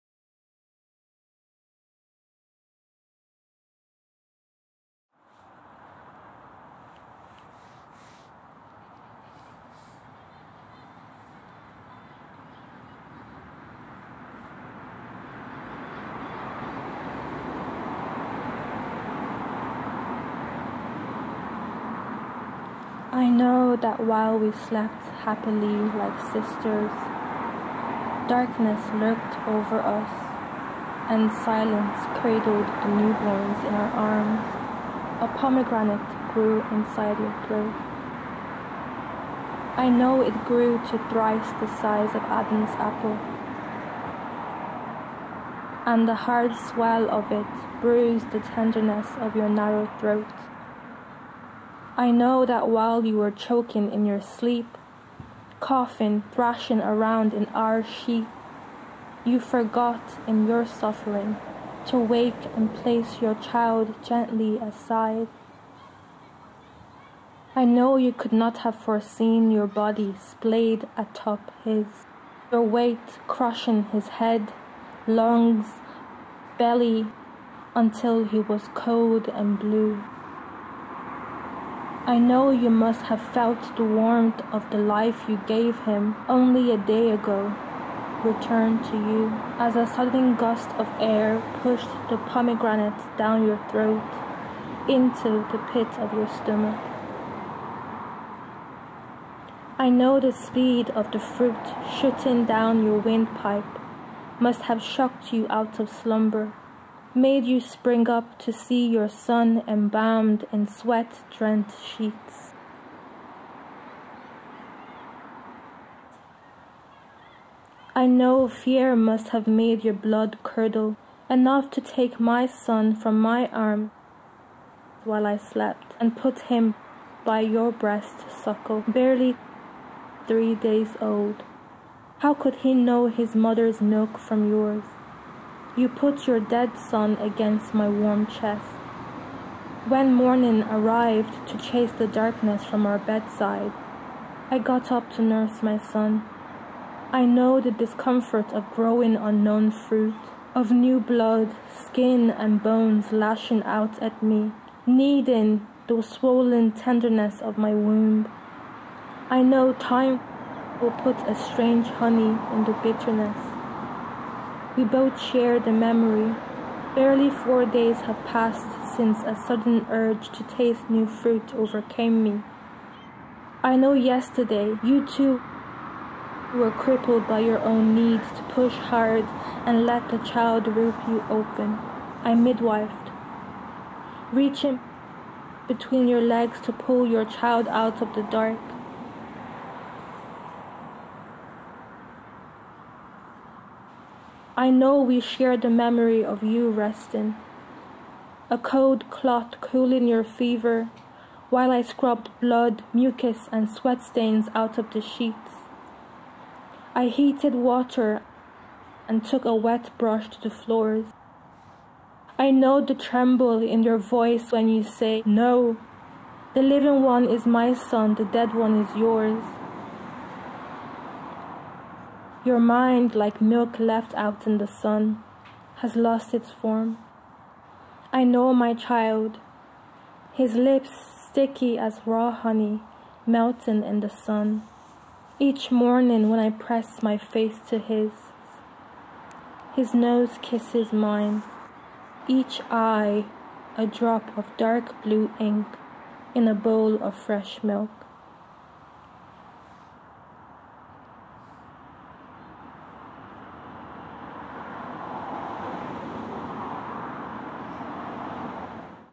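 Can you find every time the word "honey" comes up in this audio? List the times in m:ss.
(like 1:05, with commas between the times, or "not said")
2:41, 3:52.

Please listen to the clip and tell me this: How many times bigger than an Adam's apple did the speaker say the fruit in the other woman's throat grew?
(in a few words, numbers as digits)
3 times.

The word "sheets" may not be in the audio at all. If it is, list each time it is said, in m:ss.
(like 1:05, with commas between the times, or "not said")
0:57, 1:51, 3:25.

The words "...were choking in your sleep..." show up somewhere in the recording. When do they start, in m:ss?
0:53.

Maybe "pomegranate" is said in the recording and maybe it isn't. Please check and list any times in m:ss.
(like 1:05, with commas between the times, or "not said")
0:35, 1:32.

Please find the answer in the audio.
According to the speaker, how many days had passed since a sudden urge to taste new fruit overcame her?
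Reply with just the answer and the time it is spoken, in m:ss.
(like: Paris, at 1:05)
4, at 2:47.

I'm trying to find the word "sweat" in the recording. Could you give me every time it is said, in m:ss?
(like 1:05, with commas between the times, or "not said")
1:50, 3:23.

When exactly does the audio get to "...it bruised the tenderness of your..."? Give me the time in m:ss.
0:47.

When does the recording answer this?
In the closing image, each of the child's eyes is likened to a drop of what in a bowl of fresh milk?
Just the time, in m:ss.
4:04.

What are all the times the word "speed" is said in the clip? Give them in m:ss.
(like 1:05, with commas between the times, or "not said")
1:40.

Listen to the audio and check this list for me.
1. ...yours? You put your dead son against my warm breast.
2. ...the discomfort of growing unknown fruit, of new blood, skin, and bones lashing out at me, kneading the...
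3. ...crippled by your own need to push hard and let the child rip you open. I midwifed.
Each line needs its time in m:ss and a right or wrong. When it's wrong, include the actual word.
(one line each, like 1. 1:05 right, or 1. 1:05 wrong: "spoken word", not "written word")
1. 2:14 wrong: "chest", not "breast"
2. 2:27 right
3. 2:56 right.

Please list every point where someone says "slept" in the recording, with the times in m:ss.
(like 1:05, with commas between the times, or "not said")
0:24, 2:05.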